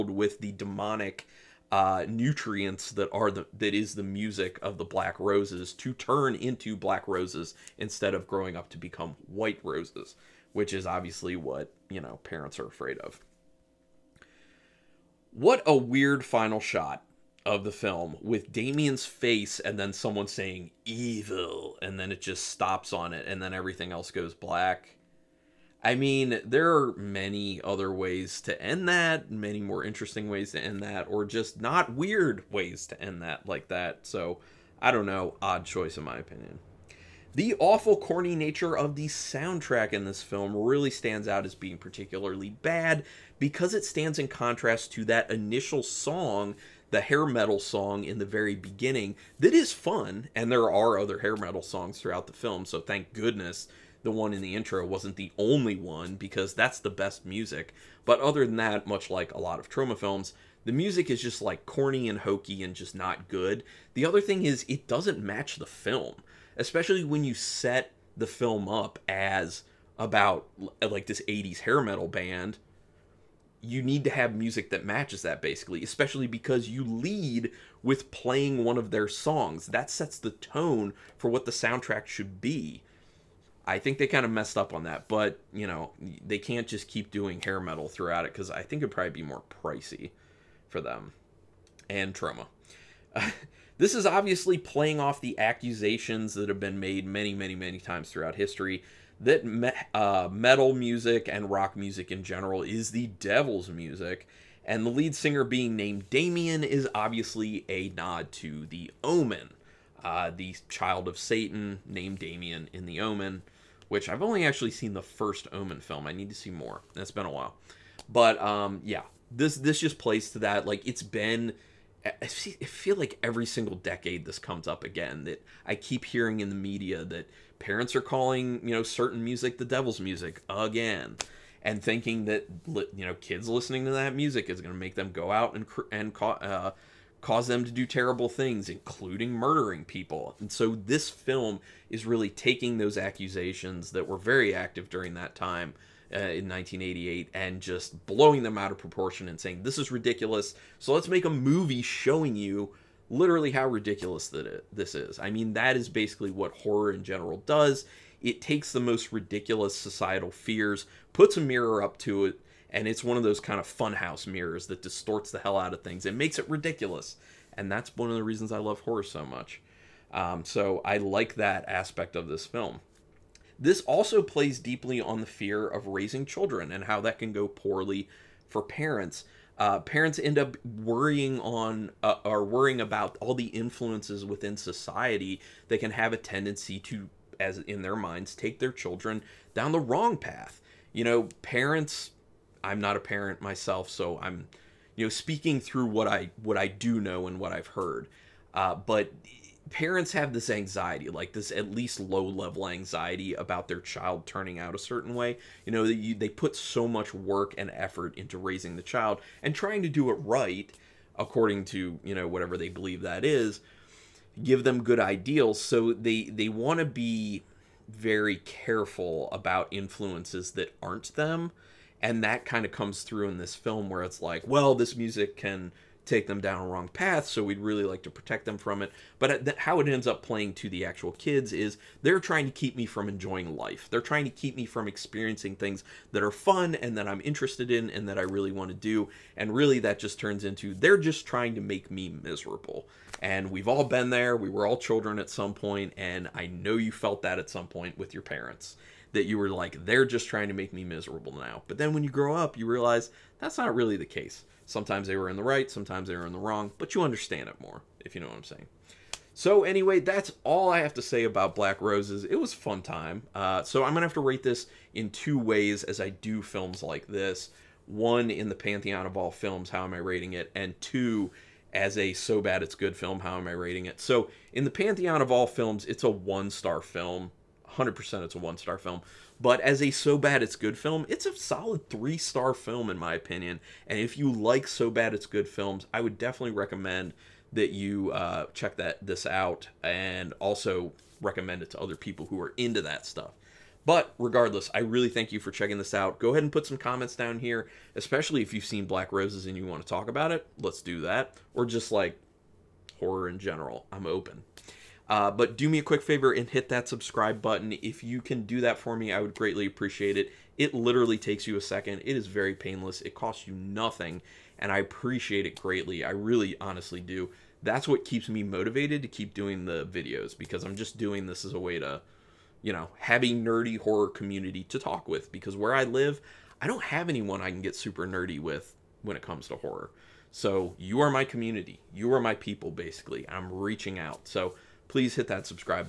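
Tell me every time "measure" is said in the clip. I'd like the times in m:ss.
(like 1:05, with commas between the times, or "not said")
not said.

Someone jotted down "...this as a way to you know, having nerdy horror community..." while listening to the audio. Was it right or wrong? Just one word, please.
right.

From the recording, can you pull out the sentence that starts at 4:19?
So anyway, that's all I have to say about Black Roses.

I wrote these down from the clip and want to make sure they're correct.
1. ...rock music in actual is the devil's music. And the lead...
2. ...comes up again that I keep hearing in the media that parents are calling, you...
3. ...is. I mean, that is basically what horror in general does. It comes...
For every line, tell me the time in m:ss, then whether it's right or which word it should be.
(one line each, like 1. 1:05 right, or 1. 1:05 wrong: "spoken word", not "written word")
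1. 1:41 wrong: "general", not "actual"
2. 2:04 right
3. 2:34 wrong: "takes", not "comes".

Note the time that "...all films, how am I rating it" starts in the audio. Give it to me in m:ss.
4:29.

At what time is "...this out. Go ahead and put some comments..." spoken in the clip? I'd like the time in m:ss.
4:55.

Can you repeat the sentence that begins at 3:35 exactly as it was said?
So they, they want to be very careful about influences that aren't them.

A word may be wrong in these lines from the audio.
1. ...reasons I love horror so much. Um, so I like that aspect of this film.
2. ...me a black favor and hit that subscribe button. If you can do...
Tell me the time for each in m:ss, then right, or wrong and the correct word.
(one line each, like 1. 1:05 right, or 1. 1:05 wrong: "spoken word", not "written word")
1. 2:48 right
2. 5:05 wrong: "quick", not "black".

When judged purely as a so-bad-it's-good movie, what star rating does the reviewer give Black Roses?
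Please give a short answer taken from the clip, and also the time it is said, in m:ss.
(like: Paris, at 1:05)
3 stars, at 4:41.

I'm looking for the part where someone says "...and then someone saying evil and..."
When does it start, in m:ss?
0:19.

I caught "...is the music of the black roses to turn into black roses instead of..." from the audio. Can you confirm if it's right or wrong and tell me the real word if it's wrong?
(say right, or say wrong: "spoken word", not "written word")
right.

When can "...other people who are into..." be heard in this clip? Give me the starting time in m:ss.
4:51.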